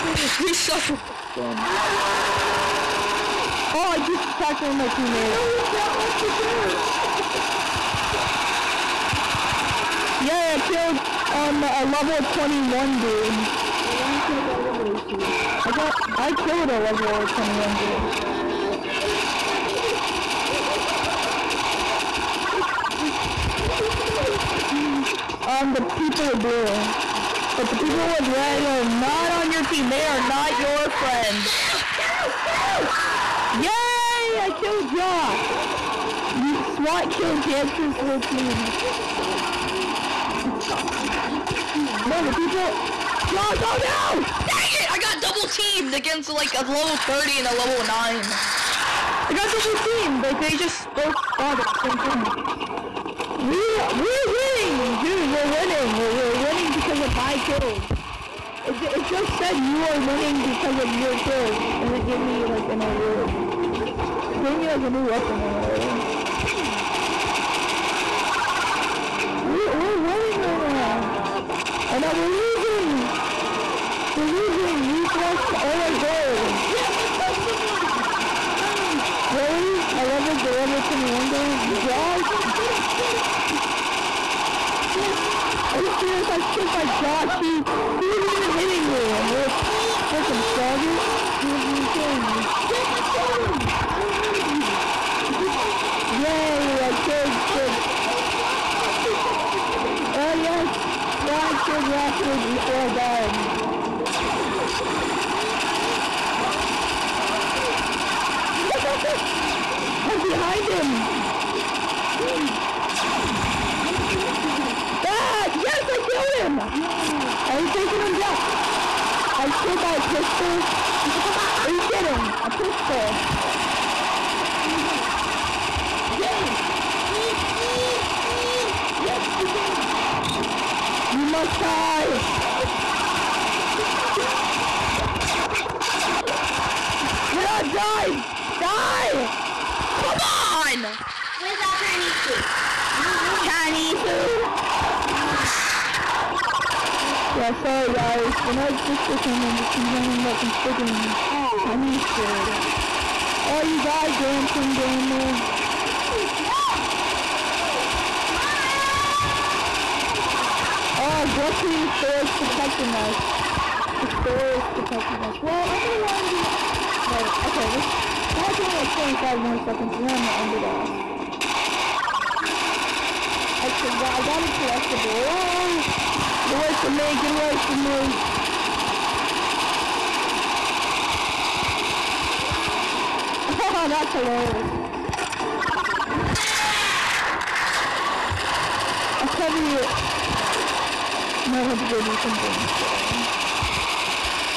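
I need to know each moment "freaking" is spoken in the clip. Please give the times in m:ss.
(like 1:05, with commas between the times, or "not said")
1:30, 2:30.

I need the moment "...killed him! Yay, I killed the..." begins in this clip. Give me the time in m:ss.
1:33.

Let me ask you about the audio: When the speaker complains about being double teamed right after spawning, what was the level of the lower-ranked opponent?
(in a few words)
9.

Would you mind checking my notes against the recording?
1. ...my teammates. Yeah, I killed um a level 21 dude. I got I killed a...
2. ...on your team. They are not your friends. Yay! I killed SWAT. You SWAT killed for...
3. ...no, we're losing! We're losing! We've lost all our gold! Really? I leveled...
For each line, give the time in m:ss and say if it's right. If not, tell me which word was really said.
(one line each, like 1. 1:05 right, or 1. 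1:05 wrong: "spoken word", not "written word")
1. 0:04 right
2. 0:29 wrong: "Josh", not "SWAT"
3. 1:11 right.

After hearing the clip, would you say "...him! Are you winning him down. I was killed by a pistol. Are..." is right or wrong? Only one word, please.
wrong.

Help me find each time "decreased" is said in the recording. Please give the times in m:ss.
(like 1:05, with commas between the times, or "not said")
not said.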